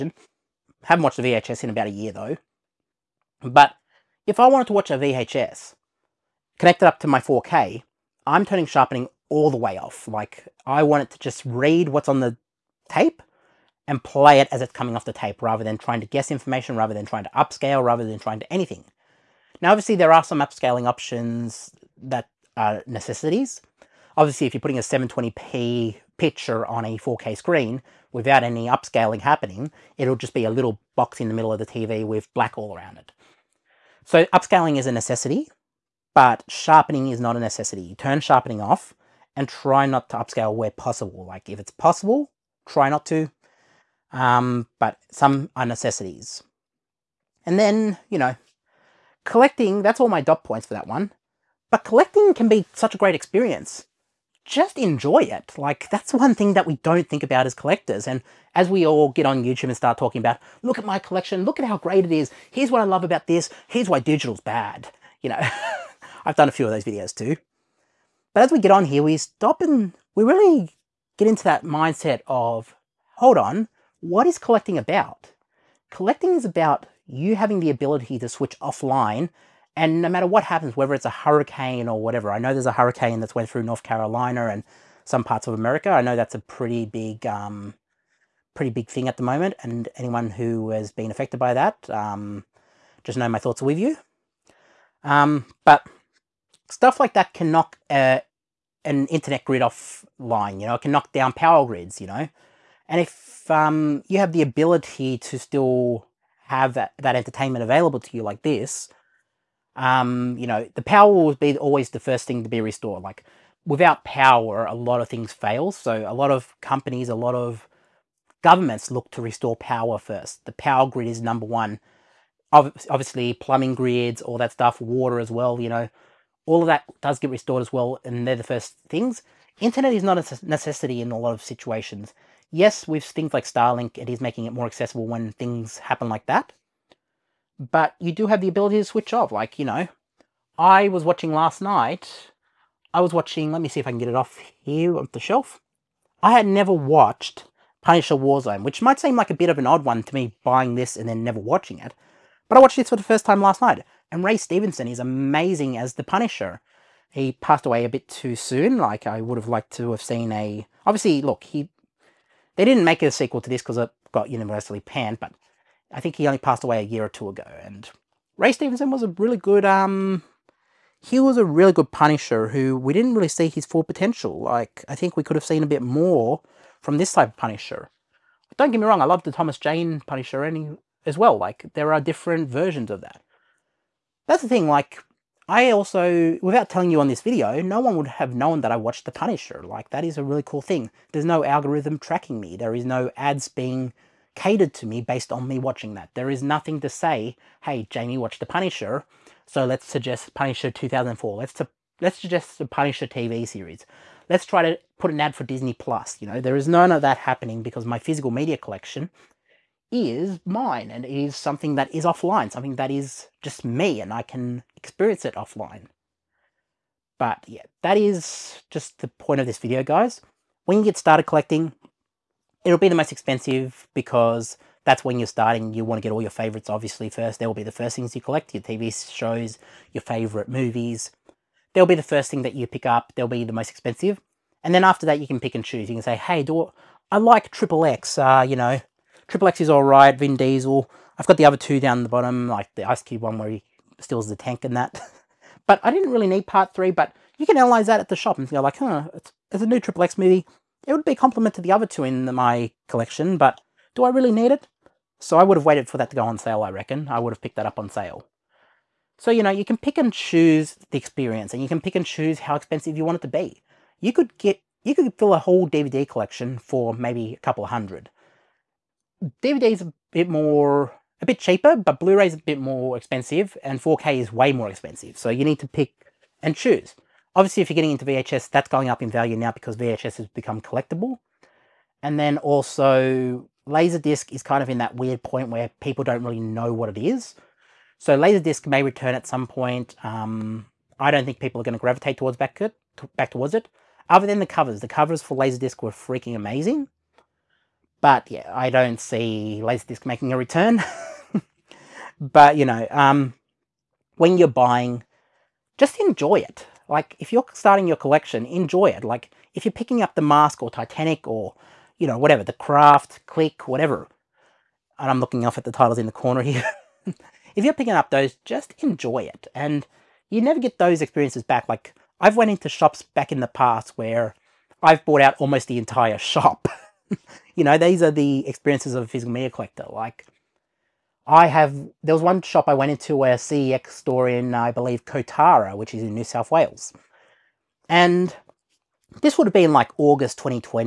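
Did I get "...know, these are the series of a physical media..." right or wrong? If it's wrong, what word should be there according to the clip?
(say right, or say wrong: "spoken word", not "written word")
wrong: "experiences", not "series".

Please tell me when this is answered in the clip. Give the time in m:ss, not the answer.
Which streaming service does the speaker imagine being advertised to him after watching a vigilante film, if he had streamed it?
3:25.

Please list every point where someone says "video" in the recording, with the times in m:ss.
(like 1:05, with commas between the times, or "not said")
1:06, 3:07, 3:39.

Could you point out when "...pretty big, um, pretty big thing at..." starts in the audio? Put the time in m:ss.
1:26.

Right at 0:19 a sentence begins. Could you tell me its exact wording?
Now, obviously, there are some upscaling options that uh, necessities.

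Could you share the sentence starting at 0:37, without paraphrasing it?
You turn sharpening off and try not to upscale where possible.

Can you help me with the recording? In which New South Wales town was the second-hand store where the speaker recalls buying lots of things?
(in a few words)
Kotara.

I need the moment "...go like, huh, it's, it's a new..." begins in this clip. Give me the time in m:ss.
4:08.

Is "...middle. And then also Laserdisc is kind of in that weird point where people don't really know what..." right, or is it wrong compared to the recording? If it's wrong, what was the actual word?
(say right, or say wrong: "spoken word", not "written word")
wrong: "collectible", not "middle".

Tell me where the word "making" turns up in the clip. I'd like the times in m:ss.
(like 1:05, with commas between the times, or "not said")
2:14, 5:00.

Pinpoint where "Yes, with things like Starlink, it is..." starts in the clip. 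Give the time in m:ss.
2:12.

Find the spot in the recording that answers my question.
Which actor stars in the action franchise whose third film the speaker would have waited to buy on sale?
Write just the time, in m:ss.
4:00.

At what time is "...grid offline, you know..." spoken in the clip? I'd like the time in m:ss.
1:39.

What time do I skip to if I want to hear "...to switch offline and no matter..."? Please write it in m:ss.
1:18.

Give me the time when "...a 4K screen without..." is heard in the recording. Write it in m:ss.
0:26.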